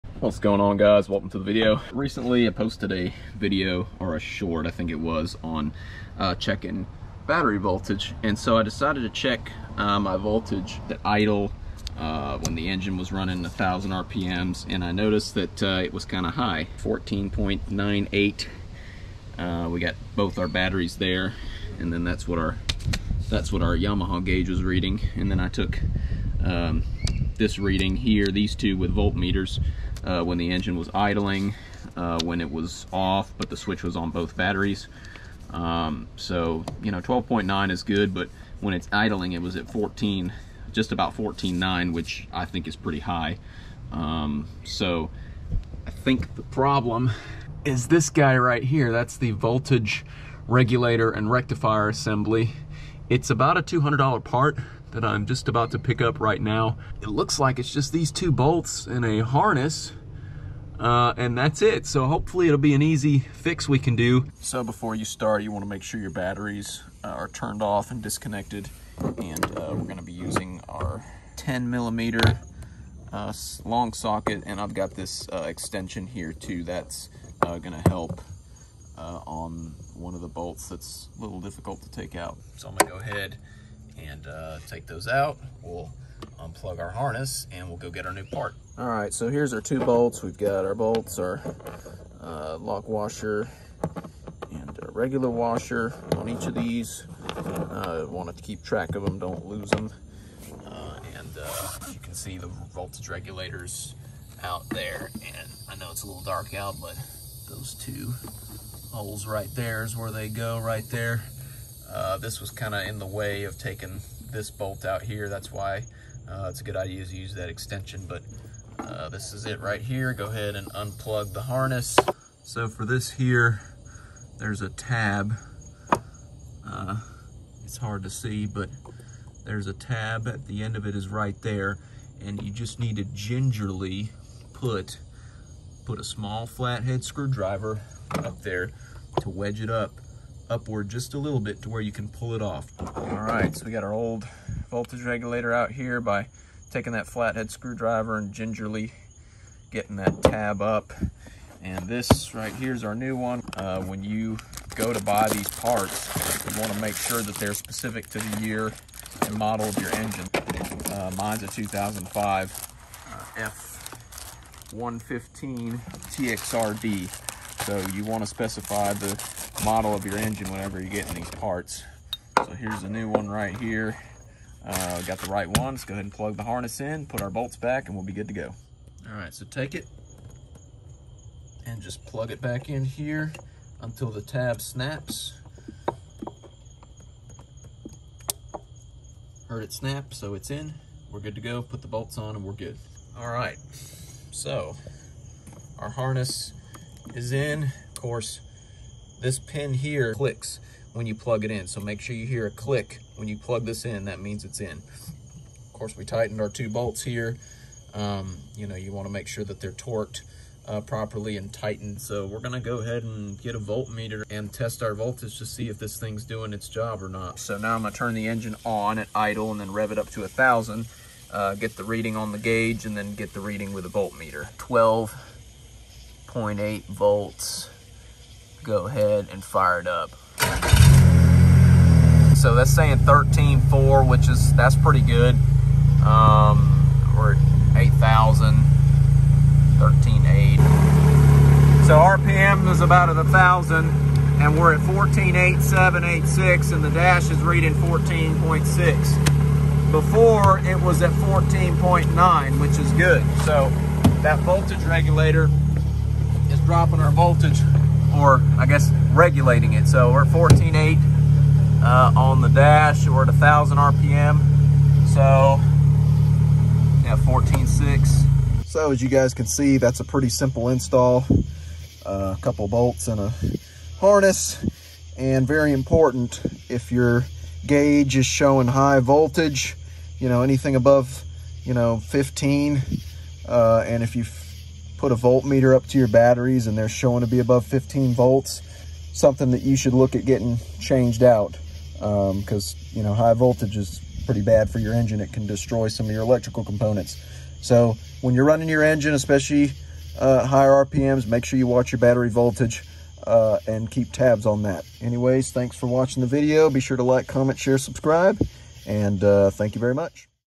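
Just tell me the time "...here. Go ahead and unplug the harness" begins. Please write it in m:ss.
1:59.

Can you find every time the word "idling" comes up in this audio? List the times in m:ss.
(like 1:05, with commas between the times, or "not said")
0:30, 0:38.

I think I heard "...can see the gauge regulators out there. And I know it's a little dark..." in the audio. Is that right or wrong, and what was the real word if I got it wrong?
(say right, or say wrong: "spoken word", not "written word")
wrong: "voltage", not "gauge".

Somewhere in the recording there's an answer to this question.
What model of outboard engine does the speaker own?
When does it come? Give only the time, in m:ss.
2:44.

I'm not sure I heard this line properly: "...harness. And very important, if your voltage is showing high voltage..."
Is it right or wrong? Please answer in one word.
wrong.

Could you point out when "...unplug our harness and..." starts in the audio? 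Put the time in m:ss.
1:26.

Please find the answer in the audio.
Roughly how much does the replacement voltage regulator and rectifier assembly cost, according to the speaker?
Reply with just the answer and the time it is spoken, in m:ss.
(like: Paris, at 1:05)
$200, at 0:53.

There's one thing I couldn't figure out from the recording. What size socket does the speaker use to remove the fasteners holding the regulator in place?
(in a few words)
10 millimeter.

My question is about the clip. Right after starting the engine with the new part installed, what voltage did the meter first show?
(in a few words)
13.4.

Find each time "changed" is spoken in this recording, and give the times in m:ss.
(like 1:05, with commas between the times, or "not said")
4:50.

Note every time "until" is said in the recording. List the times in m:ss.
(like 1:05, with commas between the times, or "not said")
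3:03.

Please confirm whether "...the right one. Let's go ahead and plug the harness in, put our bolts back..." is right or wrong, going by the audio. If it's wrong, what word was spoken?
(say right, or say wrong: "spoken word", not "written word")
right.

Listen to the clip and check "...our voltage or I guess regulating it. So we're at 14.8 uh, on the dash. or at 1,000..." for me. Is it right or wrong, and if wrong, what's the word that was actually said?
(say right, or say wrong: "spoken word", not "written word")
right.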